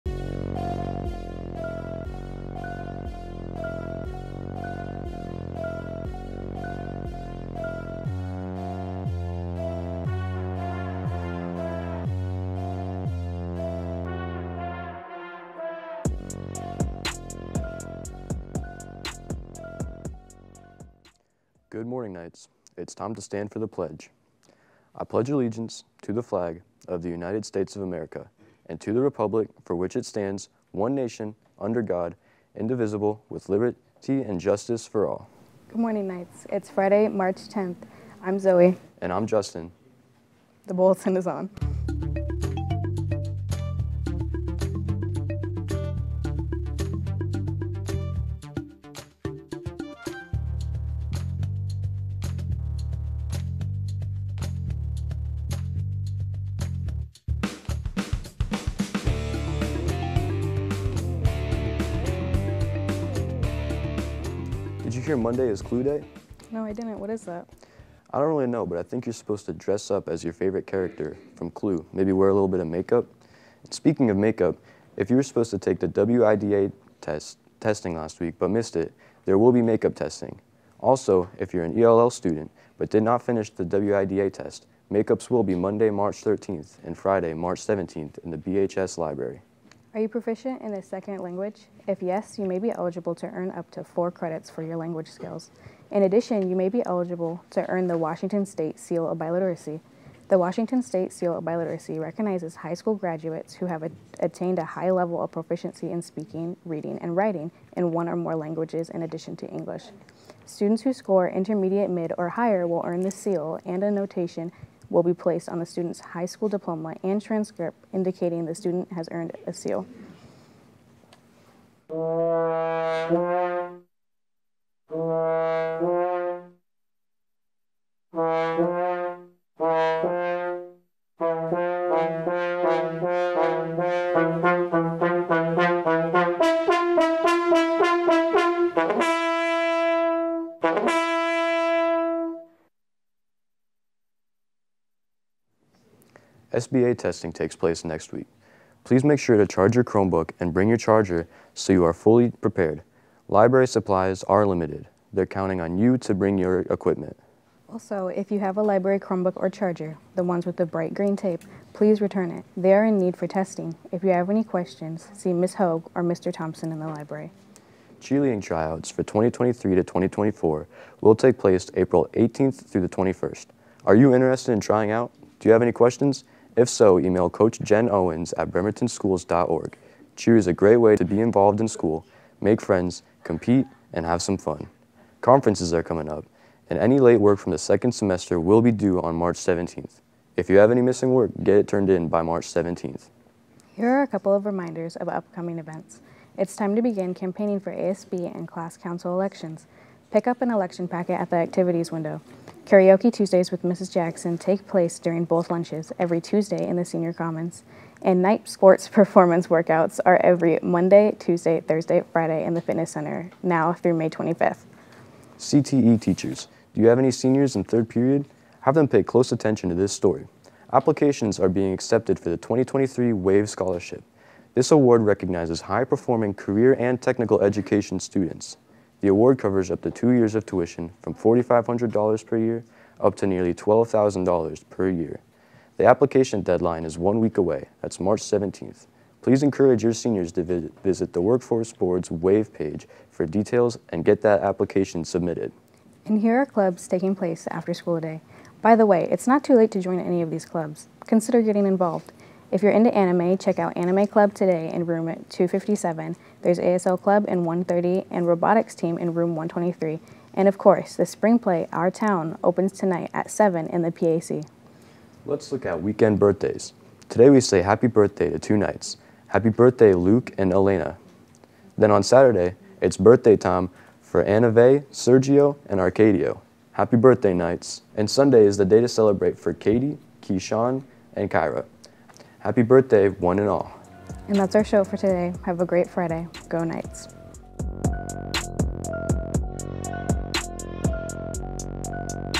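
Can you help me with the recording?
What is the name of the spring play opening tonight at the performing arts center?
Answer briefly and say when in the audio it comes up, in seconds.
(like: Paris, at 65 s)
Our Town, at 261 s.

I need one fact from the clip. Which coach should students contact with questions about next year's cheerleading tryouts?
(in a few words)
Jen Owens.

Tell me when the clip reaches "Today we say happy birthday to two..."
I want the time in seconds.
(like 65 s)
267 s.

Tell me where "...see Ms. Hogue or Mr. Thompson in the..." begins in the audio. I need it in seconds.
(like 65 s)
165 s.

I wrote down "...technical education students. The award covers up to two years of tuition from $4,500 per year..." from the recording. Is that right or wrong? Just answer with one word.
right.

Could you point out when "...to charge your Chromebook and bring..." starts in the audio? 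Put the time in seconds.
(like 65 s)
149 s.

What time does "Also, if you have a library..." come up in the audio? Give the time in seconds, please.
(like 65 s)
157 s.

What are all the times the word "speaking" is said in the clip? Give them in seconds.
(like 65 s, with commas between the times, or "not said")
73 s, 106 s.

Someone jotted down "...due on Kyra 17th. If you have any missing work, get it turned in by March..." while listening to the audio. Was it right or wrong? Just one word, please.
wrong.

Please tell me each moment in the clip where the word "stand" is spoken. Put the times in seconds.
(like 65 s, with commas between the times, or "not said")
23 s, 30 s.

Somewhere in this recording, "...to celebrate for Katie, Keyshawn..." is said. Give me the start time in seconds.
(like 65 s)
278 s.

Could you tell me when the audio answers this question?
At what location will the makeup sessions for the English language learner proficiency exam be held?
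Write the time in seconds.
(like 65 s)
88 s.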